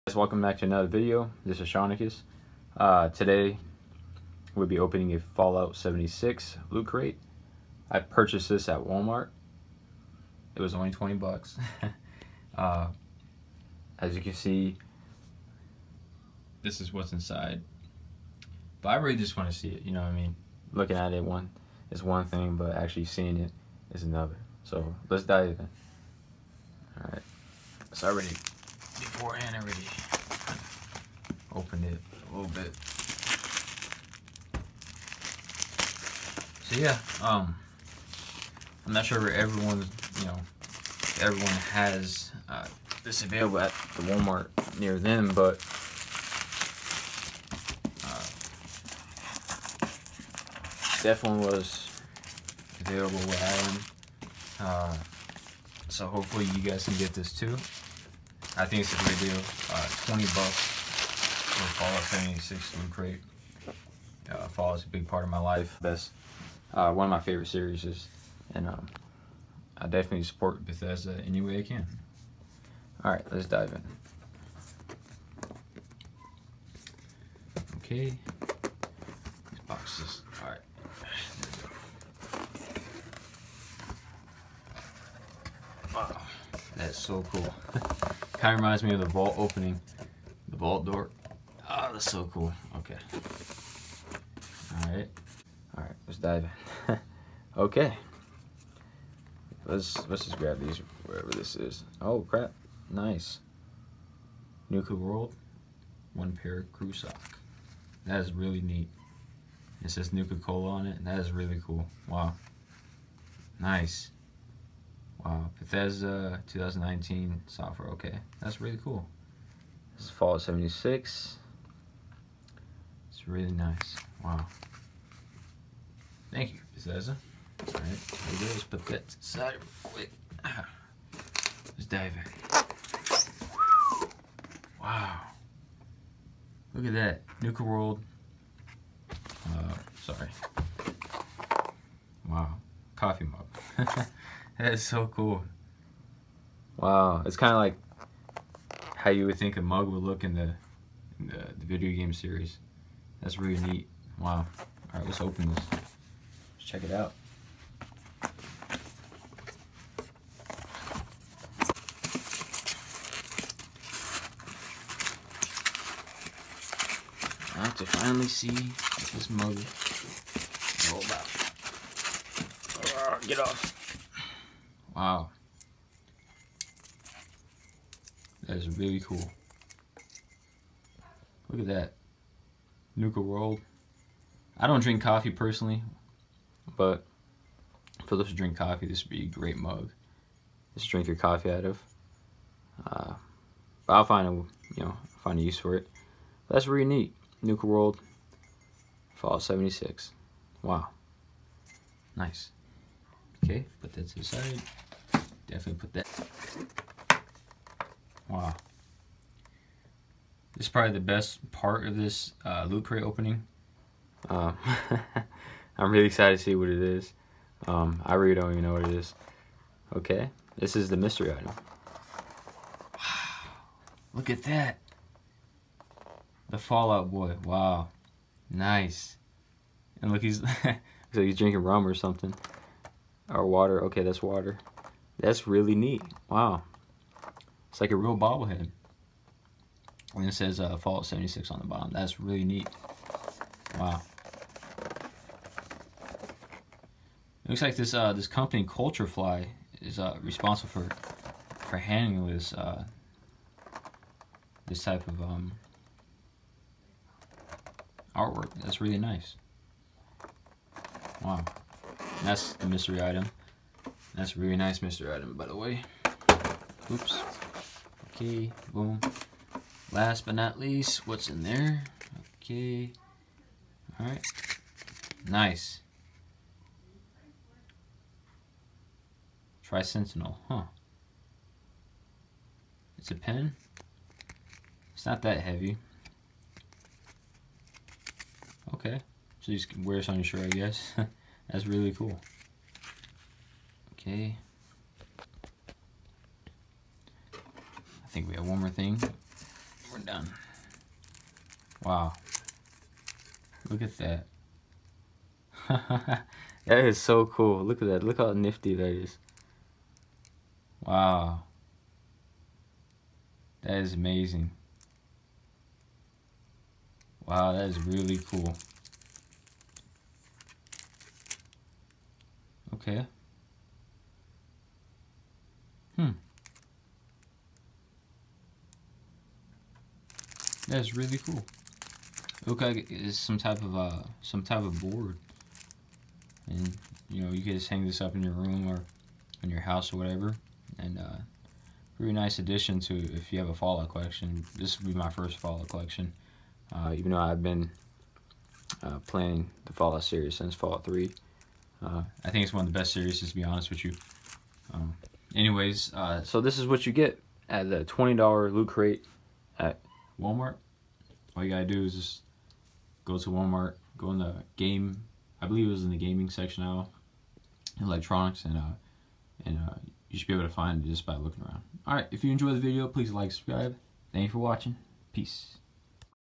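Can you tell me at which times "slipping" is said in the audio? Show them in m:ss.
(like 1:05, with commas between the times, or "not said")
not said.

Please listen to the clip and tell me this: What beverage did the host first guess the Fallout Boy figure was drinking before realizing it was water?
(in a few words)
rum.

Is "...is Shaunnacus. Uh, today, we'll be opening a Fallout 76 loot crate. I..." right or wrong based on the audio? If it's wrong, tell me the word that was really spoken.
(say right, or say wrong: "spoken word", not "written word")
right.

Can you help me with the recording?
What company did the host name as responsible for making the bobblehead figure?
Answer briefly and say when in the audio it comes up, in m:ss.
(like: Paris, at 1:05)
Culturefly, at 4:08.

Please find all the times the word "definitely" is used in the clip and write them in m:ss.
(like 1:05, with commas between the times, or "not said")
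0:51, 1:09, 3:25.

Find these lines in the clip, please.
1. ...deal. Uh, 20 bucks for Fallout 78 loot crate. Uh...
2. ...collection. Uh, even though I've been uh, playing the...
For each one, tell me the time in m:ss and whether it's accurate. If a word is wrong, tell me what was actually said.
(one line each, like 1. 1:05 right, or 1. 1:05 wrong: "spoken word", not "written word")
1. 0:59 wrong: "76", not "78"
2. 5:45 right.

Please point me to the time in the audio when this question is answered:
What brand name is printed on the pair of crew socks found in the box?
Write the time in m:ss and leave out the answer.
1:50.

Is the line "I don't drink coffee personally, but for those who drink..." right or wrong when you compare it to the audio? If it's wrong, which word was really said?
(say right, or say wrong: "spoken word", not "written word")
right.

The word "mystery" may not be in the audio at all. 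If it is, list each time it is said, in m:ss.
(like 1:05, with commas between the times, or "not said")
3:40, 4:22.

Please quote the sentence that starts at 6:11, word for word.
Alright, if you enjoyed the video, please like, subscribe.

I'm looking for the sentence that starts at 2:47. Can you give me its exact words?
I have to finally see what this mug is all about.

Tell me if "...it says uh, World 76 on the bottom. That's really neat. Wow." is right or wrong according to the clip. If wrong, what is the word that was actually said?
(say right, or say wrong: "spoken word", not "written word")
wrong: "Fallout", not "World".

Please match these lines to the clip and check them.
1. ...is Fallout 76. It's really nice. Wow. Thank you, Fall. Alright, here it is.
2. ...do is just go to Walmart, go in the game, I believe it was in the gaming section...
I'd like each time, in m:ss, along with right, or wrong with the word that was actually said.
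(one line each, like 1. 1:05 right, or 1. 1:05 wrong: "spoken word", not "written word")
1. 2:00 wrong: "Bethesda", not "Fall"
2. 6:01 right.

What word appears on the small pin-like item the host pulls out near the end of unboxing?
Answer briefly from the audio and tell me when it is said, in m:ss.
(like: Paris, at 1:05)
Tricentennial, at 4:39.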